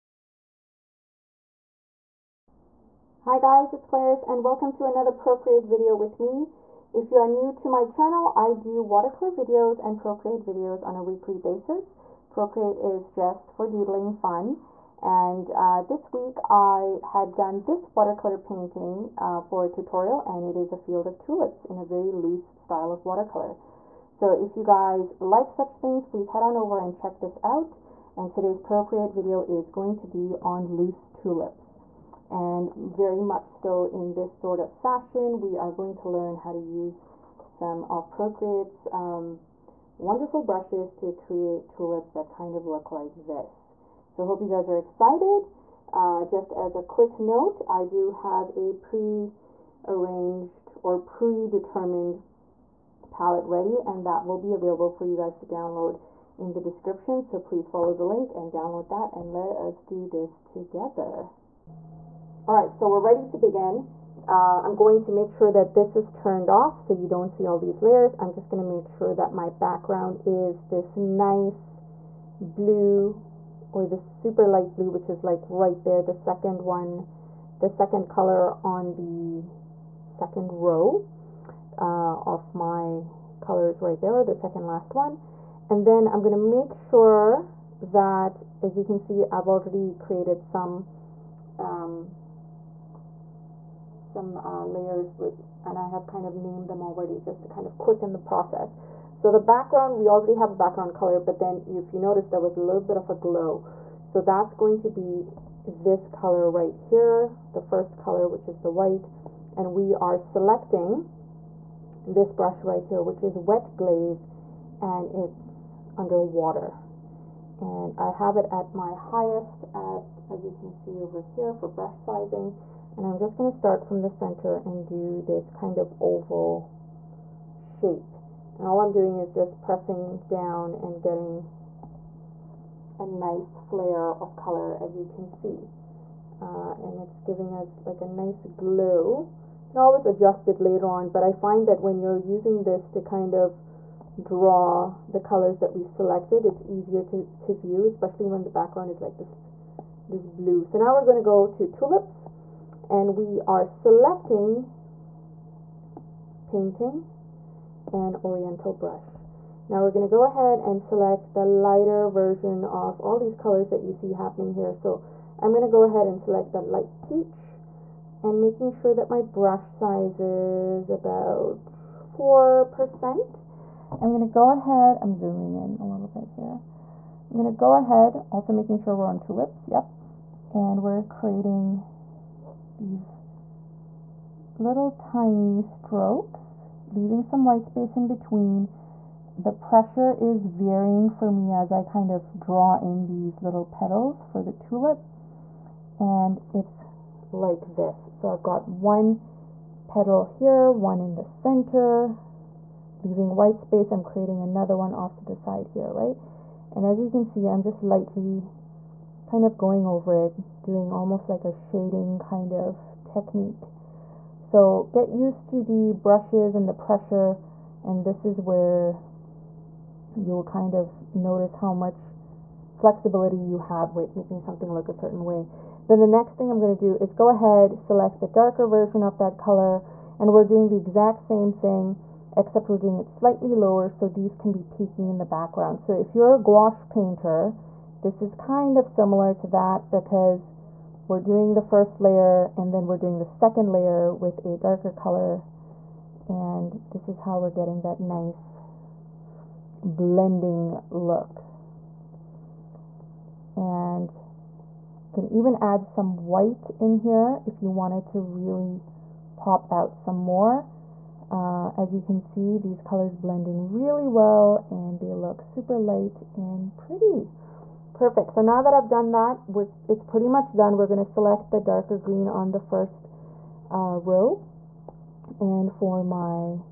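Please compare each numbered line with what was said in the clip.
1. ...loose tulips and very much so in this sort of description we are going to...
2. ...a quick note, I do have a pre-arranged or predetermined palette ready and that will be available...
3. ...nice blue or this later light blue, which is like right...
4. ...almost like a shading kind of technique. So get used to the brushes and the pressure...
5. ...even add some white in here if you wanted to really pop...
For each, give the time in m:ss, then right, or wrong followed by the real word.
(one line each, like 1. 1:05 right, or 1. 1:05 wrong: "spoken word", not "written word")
1. 0:30 wrong: "fashion", not "description"
2. 0:46 right
3. 1:10 wrong: "super", not "later"
4. 3:30 right
5. 4:15 right.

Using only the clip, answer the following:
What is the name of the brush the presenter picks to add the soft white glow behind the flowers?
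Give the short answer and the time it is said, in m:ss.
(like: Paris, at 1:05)
Wet glaze, at 1:53.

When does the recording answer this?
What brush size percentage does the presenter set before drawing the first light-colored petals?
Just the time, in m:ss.
2:51.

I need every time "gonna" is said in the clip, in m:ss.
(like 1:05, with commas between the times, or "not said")
4:30.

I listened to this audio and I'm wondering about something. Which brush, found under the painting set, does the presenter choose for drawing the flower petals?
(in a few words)
Oriental brush.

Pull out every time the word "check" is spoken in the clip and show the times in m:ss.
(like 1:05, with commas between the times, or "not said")
0:26.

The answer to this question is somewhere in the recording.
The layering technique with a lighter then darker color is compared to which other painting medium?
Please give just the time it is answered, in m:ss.
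3:56.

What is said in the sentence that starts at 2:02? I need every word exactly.
And I'm just going to start from the center and do this kind of oval shape.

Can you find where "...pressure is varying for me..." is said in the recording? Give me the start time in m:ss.
3:09.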